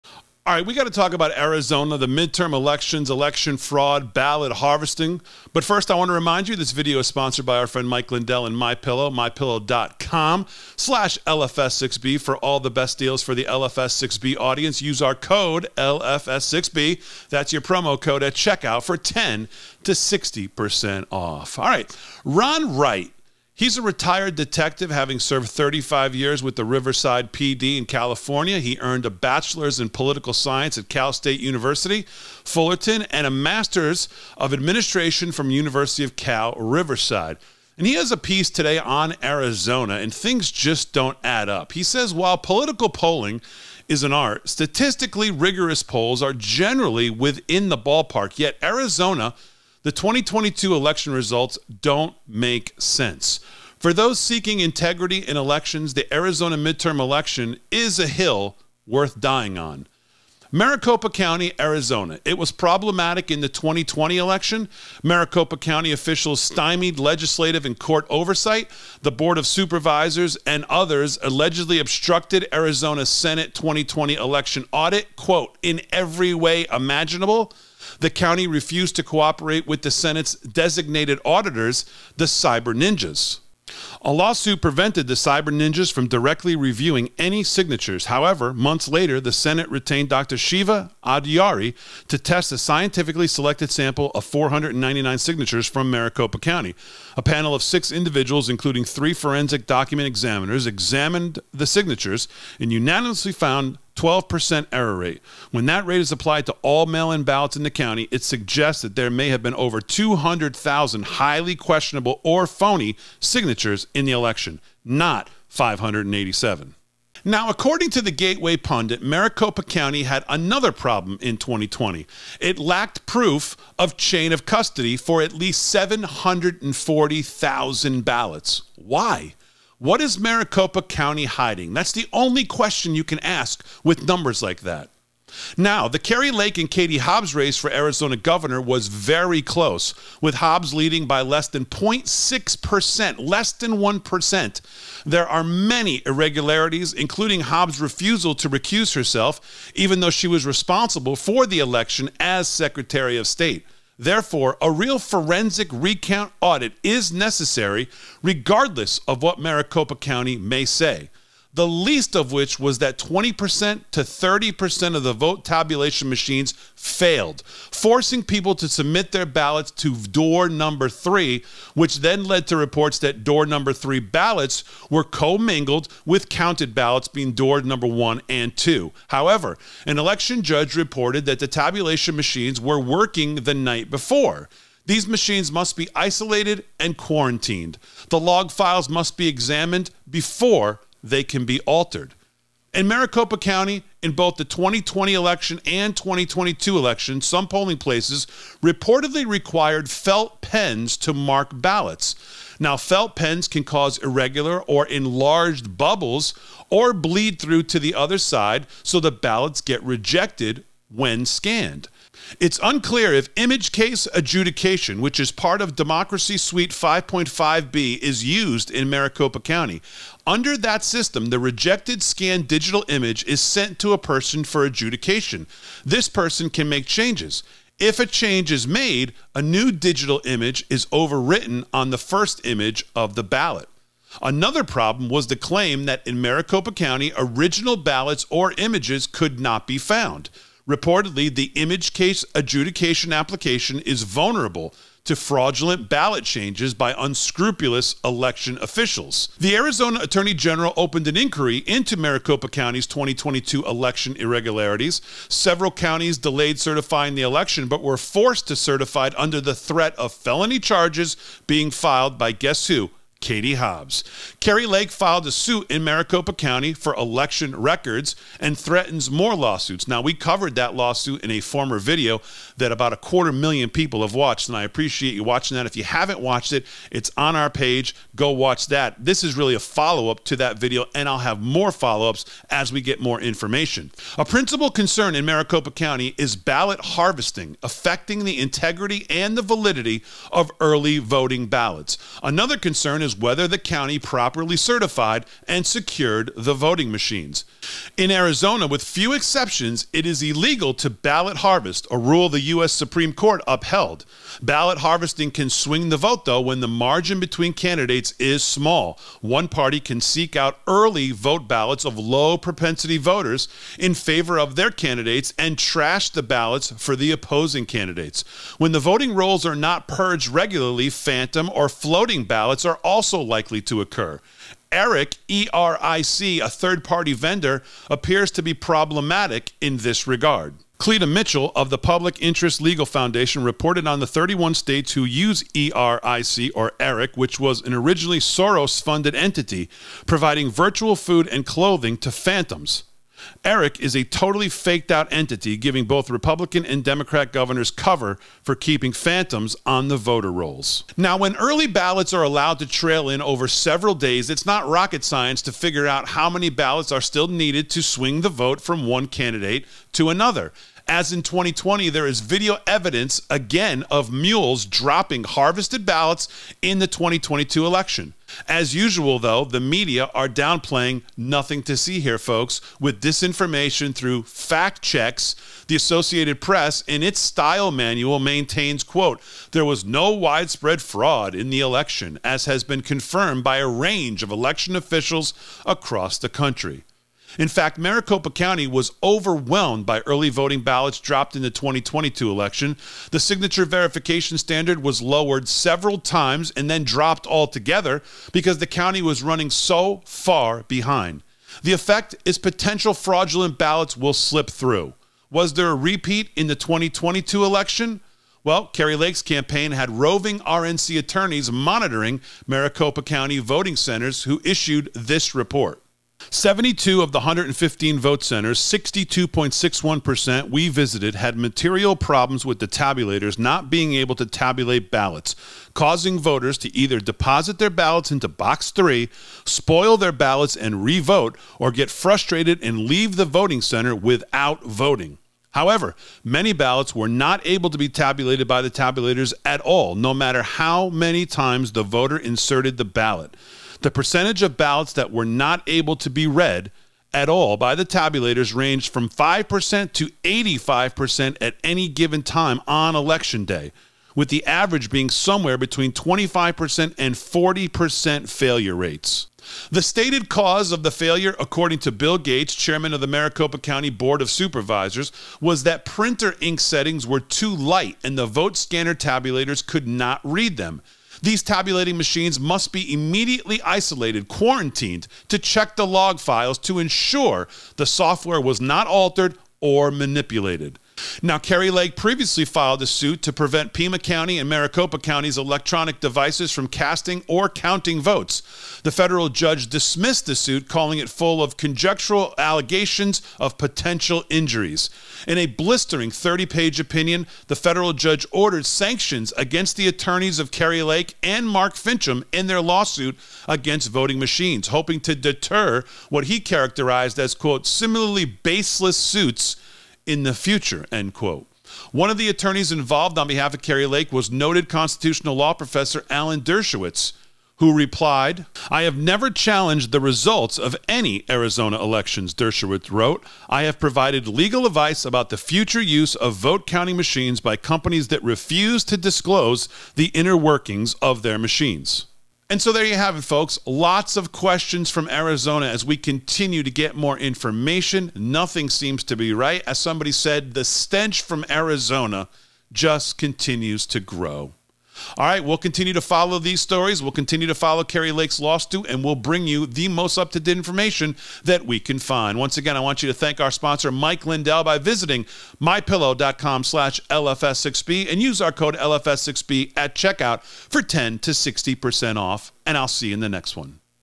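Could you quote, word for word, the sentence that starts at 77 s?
The county refused to cooperate with the Senate's designated auditors, the Cyber Ninjas.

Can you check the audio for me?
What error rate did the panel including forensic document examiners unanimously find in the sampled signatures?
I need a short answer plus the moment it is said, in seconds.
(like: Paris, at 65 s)
12%, at 103 s.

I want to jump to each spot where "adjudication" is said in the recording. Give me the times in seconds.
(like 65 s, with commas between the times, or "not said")
214 s, 224 s, 242 s.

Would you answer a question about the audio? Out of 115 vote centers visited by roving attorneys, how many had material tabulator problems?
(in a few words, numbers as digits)
72.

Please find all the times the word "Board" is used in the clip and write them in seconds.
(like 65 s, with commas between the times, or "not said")
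69 s, 463 s.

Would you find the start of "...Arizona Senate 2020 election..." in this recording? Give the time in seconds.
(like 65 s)
72 s.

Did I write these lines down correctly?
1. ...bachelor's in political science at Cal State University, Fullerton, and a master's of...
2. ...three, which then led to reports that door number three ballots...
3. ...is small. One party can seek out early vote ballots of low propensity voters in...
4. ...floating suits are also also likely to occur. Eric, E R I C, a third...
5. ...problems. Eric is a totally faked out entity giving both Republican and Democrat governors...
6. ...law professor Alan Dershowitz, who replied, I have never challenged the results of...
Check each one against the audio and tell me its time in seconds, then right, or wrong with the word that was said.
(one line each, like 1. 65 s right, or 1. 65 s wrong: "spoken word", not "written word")
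1. 29 s right
2. 170 s right
3. 308 s right
4. 321 s wrong: "ballots", not "suits"
5. 342 s wrong: "phantoms", not "problems"
6. 515 s right.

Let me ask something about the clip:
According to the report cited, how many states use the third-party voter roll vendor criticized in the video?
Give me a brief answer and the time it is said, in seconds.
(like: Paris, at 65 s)
31, at 334 s.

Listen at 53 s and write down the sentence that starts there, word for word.
For those seeking integrity in elections, the Arizona midterm election is a hill worth dying on.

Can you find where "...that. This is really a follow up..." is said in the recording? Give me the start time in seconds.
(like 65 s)
278 s.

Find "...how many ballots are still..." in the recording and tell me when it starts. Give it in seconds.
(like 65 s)
356 s.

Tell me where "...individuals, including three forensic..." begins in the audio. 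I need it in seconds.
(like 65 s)
97 s.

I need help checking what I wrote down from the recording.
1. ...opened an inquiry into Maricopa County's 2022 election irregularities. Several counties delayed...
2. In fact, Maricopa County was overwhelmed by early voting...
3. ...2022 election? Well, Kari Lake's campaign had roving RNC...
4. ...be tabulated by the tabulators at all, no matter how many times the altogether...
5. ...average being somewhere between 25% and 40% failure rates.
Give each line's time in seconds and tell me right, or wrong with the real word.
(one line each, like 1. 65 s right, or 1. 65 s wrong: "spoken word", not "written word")
1. 250 s right
2. 387 s right
3. 406 s right
4. 437 s wrong: "voter", not "altogether"
5. 454 s right.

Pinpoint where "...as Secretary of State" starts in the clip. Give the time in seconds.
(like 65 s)
152 s.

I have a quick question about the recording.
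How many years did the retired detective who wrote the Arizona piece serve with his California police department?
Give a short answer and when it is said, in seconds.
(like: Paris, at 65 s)
35, at 25 s.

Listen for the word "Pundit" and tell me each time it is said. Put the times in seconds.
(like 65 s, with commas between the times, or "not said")
118 s.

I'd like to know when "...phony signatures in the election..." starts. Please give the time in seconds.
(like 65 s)
112 s.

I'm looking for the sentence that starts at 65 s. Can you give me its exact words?
Maricopa County officials stymied legislative and court oversight.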